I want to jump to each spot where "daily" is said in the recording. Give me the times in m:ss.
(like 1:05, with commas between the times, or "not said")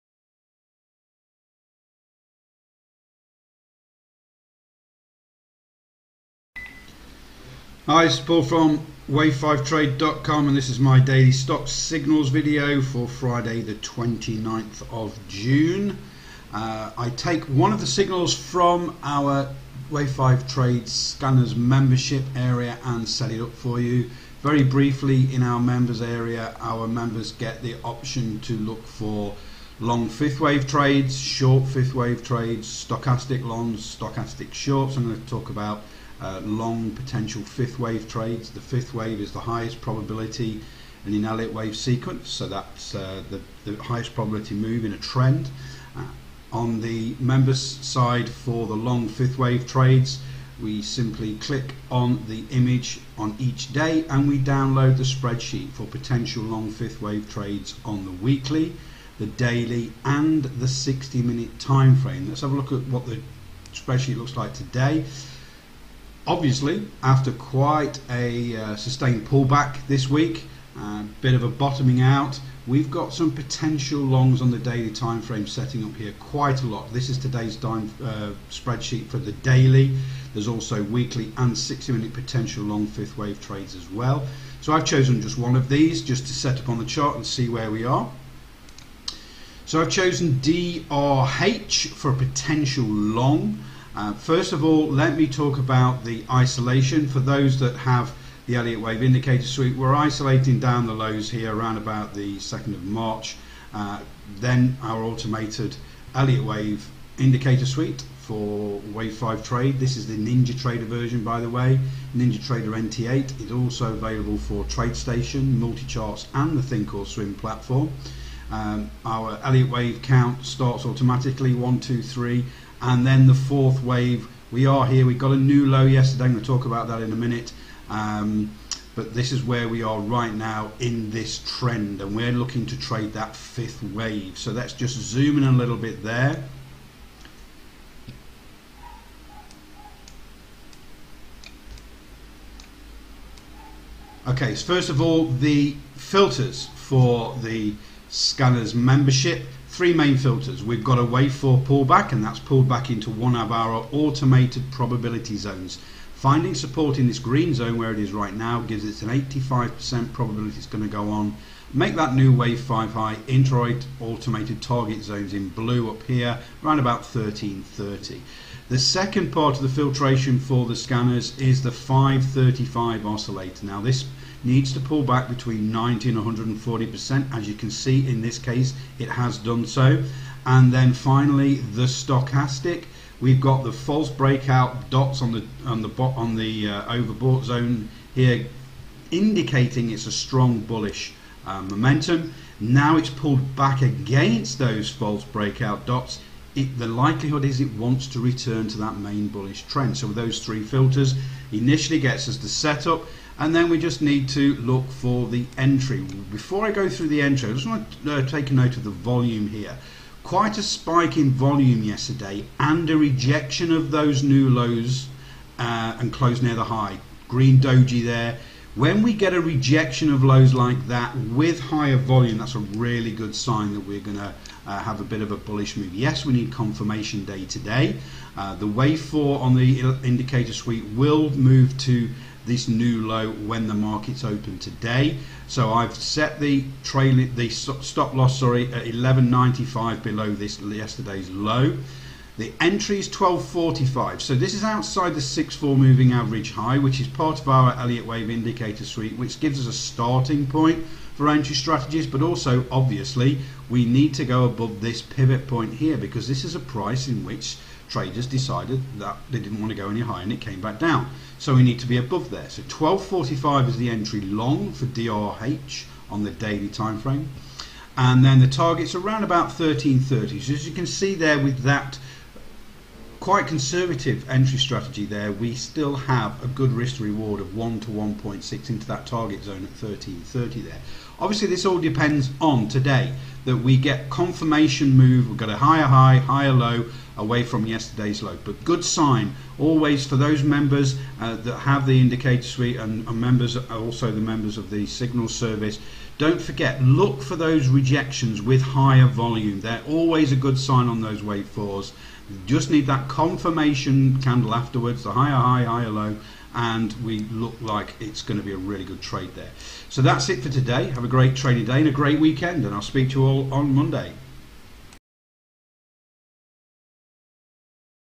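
0:10, 0:59, 1:14, 1:19, 4:26.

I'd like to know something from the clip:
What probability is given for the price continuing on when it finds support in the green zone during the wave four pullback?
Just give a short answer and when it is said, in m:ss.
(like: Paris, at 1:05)
85%, at 2:39.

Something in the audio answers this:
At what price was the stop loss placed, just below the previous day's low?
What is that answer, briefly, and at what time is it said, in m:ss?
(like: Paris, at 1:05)
11.95, at 3:58.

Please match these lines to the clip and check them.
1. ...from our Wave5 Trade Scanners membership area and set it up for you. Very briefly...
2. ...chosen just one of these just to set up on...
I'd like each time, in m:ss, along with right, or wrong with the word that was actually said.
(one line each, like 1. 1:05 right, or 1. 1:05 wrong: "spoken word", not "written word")
1. 0:18 right
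2. 1:24 right.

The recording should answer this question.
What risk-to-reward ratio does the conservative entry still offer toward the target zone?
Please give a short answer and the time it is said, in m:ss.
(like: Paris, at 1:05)
1 to 1.6, at 4:37.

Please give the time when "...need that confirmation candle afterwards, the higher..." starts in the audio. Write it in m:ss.
5:02.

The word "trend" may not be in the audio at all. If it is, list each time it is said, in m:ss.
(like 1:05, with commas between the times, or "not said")
0:44, 2:11, 3:19.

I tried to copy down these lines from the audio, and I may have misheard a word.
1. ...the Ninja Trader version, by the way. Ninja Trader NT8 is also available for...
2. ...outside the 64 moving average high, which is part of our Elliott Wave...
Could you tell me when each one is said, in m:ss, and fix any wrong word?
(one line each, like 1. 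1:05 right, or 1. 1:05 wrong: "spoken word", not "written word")
1. 1:50 right
2. 4:04 right.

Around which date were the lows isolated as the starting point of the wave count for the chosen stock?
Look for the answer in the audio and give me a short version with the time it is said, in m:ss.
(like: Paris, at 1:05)
2nd of March, at 1:42.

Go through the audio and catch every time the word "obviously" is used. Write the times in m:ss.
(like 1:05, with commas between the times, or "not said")
1:06, 4:12, 4:41.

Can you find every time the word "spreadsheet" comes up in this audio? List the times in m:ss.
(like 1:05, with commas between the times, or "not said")
0:55, 1:03, 1:18.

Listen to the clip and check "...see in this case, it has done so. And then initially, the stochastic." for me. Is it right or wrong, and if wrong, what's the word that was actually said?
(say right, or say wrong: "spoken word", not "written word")
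wrong: "finally", not "initially".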